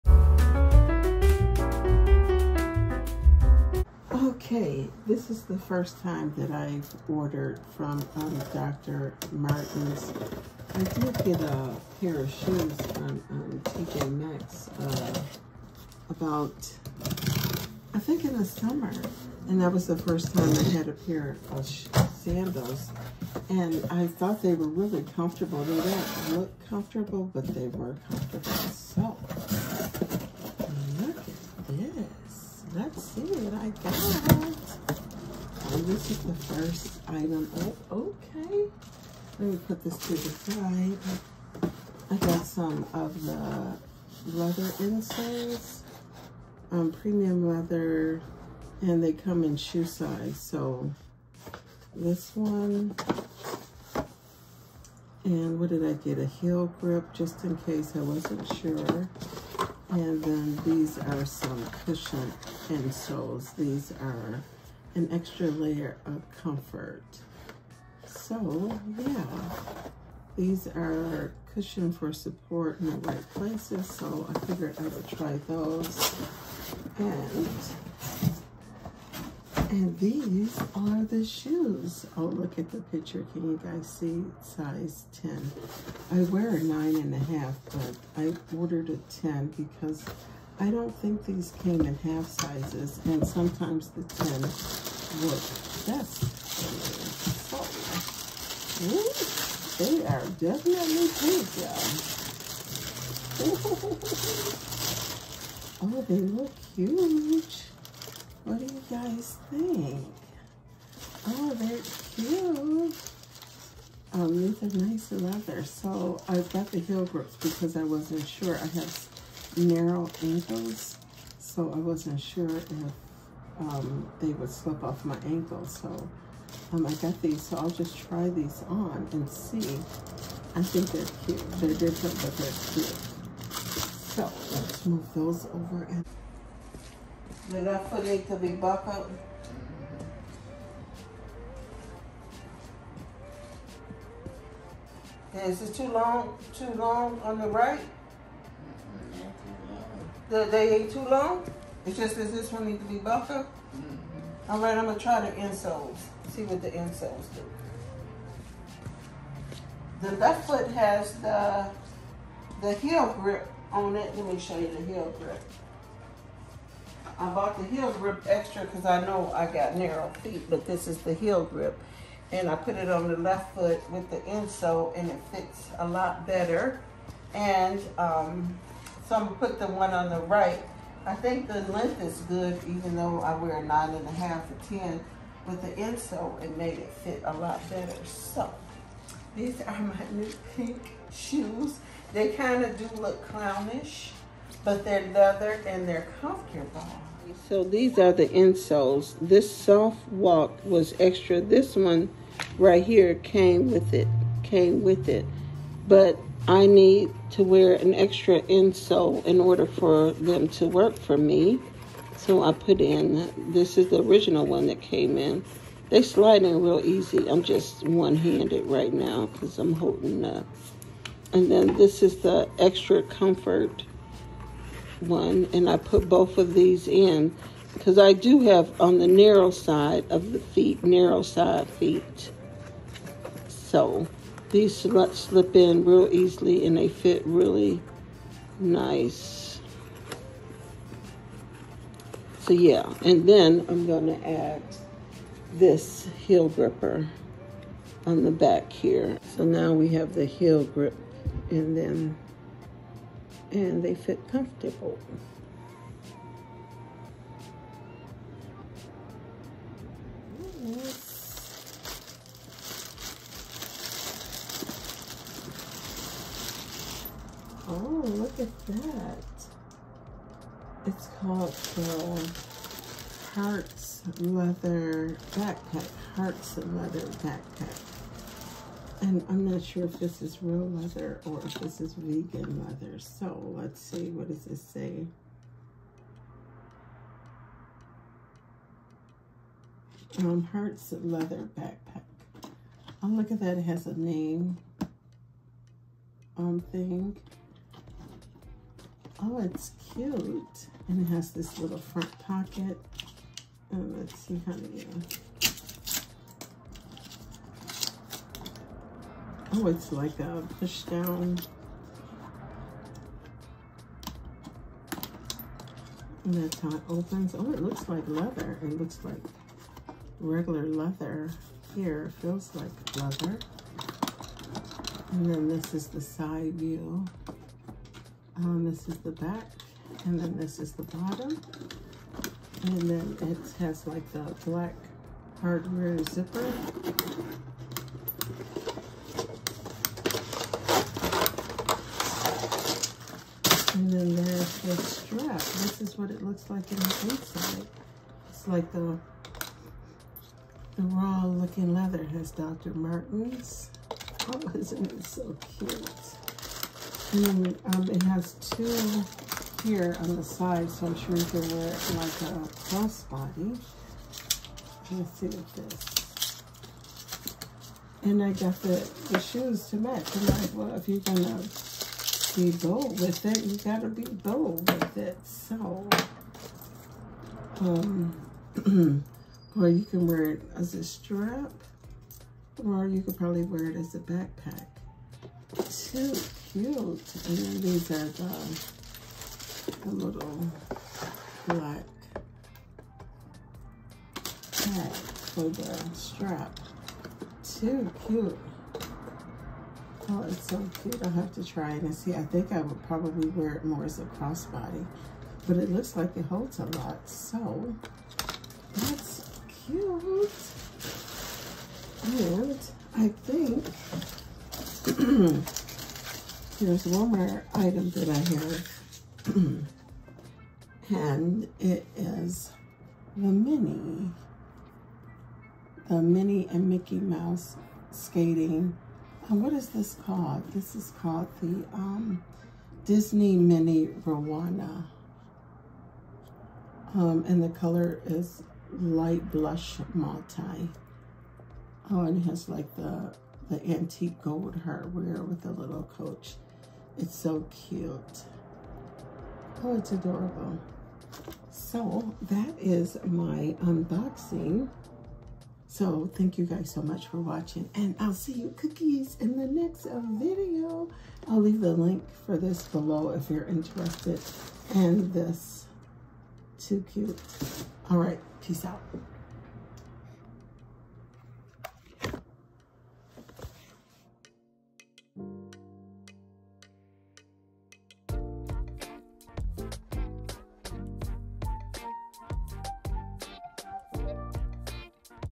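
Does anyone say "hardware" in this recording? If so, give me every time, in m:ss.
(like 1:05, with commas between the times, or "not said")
5:35, 7:24.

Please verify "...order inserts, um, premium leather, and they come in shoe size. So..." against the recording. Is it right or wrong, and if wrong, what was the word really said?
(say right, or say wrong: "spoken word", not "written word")
wrong: "leather", not "order".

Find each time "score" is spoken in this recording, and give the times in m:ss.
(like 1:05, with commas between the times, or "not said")
not said.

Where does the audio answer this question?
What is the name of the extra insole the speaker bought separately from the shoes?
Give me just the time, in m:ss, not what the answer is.
3:19.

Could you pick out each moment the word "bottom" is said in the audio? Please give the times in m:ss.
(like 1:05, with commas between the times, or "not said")
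5:30.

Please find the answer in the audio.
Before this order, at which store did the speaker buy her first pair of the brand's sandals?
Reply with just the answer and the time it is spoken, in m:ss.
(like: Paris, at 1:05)
TJ Maxx, at 0:13.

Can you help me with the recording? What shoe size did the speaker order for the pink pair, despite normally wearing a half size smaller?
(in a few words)
10.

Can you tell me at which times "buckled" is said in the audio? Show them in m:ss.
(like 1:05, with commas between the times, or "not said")
2:18.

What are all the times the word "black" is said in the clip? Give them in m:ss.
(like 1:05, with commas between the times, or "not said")
5:34, 6:31.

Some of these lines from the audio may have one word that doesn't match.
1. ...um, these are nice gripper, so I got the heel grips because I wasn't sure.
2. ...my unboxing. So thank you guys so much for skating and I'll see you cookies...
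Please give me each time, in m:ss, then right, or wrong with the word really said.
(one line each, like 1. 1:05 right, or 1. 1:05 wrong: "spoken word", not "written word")
1. 1:54 wrong: "leather", not "gripper"
2. 7:33 wrong: "watching", not "skating".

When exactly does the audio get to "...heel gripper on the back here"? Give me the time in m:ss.
4:06.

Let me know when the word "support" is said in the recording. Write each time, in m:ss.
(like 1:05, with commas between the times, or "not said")
1:12.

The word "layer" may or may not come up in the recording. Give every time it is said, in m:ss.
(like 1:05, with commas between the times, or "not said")
1:05.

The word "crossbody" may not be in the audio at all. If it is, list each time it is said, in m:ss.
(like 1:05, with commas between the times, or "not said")
6:02, 6:44.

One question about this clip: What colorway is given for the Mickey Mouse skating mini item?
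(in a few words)
light blush multi.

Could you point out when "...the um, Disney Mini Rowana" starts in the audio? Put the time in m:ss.
7:11.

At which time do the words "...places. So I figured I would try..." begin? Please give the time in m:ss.
1:13.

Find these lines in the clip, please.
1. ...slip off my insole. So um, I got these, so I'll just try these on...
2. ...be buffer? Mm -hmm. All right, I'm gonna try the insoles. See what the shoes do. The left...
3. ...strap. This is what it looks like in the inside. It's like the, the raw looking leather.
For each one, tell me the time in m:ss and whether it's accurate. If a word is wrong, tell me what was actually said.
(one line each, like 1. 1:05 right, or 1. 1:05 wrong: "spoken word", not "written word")
1. 2:04 wrong: "ankle", not "insole"
2. 2:32 wrong: "insoles", not "shoes"
3. 5:44 right.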